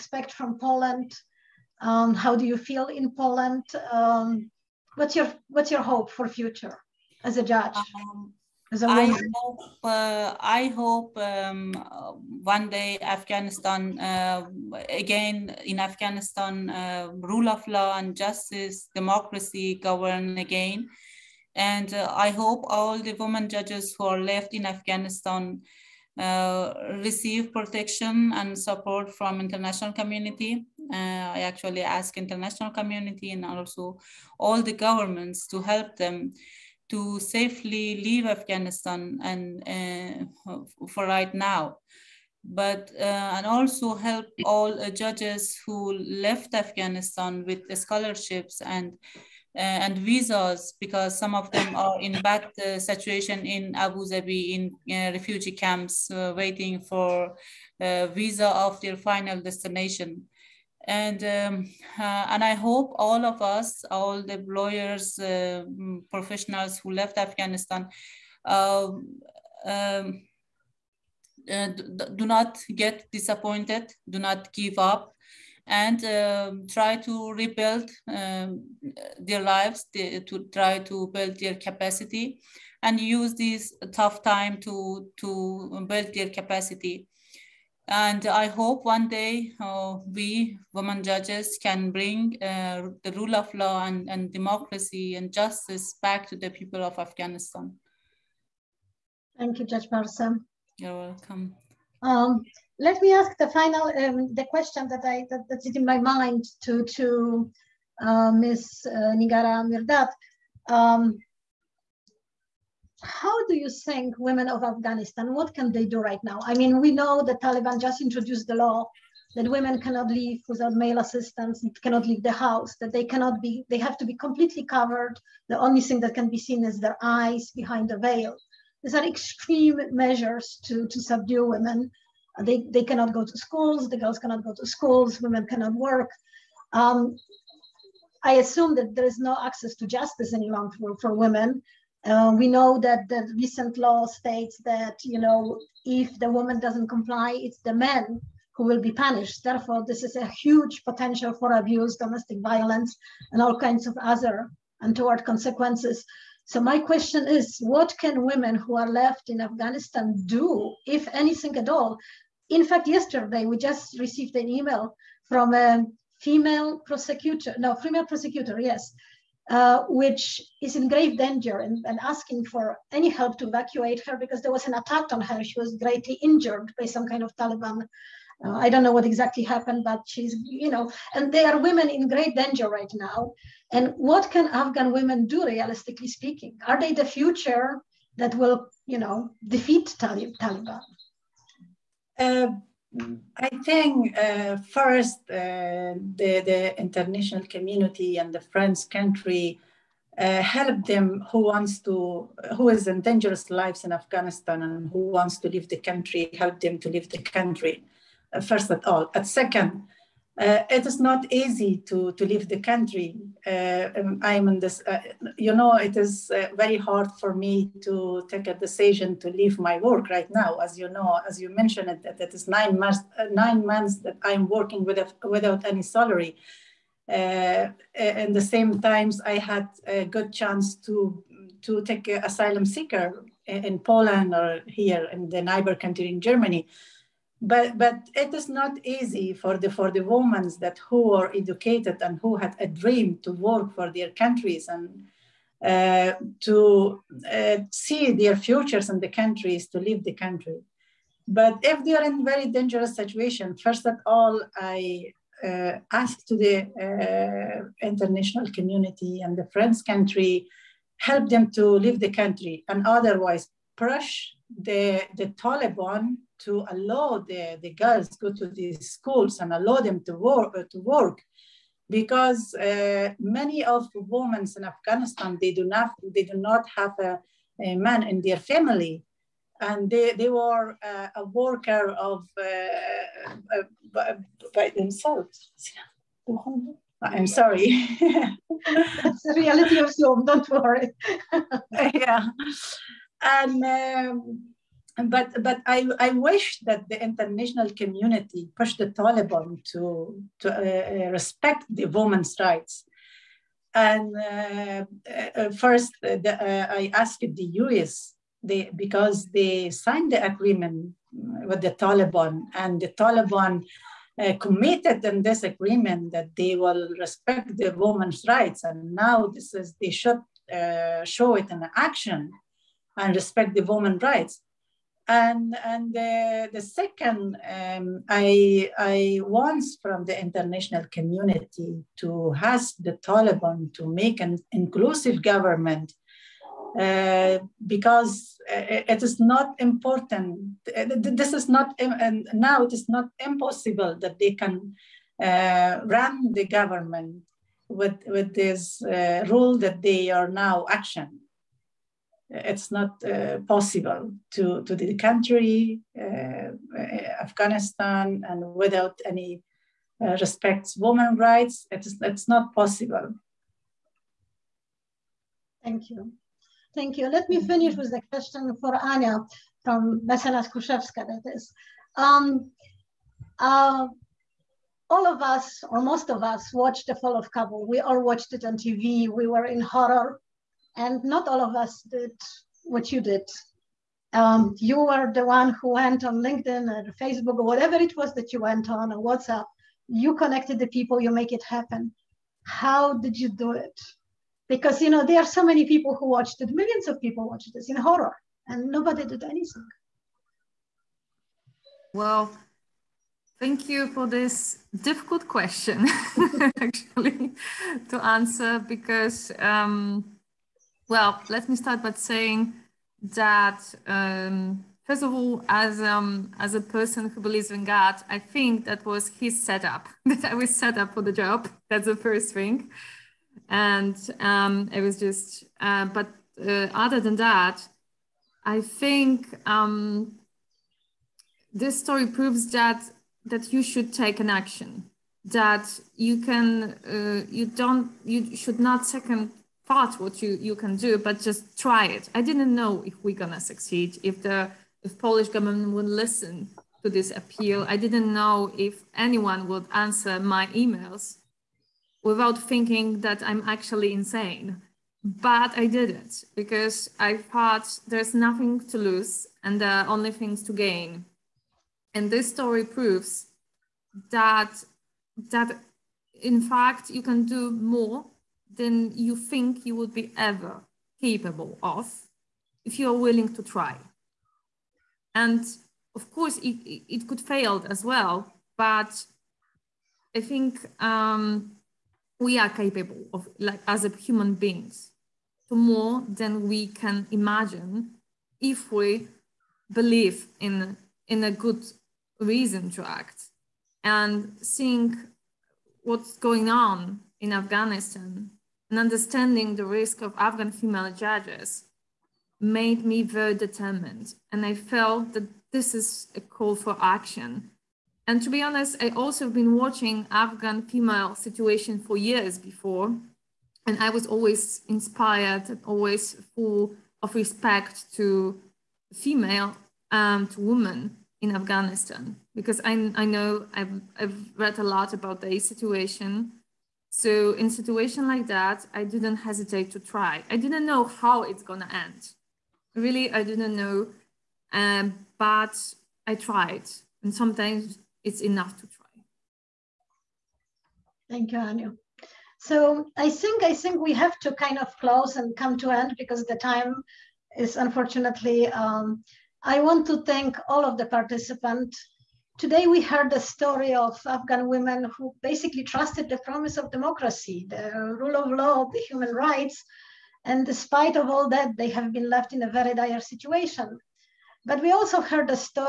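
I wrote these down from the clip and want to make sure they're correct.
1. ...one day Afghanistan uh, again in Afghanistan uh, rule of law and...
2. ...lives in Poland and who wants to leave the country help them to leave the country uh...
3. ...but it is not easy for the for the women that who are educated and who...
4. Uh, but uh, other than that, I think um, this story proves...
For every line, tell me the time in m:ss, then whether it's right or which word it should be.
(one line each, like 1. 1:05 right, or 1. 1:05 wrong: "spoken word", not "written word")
1. 0:12 right
2. 3:23 wrong: "Afghanistan", not "Poland"
3. 3:57 right
4. 7:05 right.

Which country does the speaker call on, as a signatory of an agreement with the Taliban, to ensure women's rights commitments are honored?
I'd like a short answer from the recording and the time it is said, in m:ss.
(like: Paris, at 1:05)
the U.S., at 5:07.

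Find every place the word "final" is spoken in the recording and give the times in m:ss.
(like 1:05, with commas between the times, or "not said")
0:58, 1:43.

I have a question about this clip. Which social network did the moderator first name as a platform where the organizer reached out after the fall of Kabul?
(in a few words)
LinkedIn.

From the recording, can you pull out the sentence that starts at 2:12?
They, they cannot go to schools, the girls cannot go to schools, women cannot work.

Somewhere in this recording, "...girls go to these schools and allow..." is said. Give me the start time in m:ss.
4:27.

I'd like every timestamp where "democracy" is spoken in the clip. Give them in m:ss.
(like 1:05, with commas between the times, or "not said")
0:18, 1:34, 9:16.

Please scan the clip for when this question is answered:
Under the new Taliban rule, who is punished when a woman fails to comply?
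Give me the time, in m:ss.
2:27.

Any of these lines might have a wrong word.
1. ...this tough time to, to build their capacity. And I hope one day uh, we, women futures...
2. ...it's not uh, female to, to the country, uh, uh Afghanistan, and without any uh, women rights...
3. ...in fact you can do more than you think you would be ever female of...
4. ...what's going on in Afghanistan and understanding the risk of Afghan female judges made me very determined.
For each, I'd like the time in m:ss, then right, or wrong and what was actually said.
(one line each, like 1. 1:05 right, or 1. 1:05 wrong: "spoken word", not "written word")
1. 1:23 wrong: "judges", not "futures"
2. 5:52 wrong: "possible", not "female"
3. 7:46 wrong: "capable", not "female"
4. 8:15 right.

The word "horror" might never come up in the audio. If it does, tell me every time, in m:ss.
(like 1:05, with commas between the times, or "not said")
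6:19, 6:37.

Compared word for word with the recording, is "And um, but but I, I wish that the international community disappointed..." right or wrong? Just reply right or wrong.
wrong.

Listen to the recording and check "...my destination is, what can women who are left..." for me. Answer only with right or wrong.
wrong.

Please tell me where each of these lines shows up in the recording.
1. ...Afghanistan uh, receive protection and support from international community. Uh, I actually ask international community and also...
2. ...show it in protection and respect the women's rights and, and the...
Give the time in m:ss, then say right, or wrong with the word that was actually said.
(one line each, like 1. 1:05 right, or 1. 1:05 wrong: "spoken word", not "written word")
1. 0:24 right
2. 5:21 wrong: "action", not "protection".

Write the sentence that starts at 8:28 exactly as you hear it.
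And to be honest, I also have been watching Afghan female situation for years before.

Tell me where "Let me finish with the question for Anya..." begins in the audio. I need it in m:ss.
6:07.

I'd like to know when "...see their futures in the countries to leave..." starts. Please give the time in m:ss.
4:07.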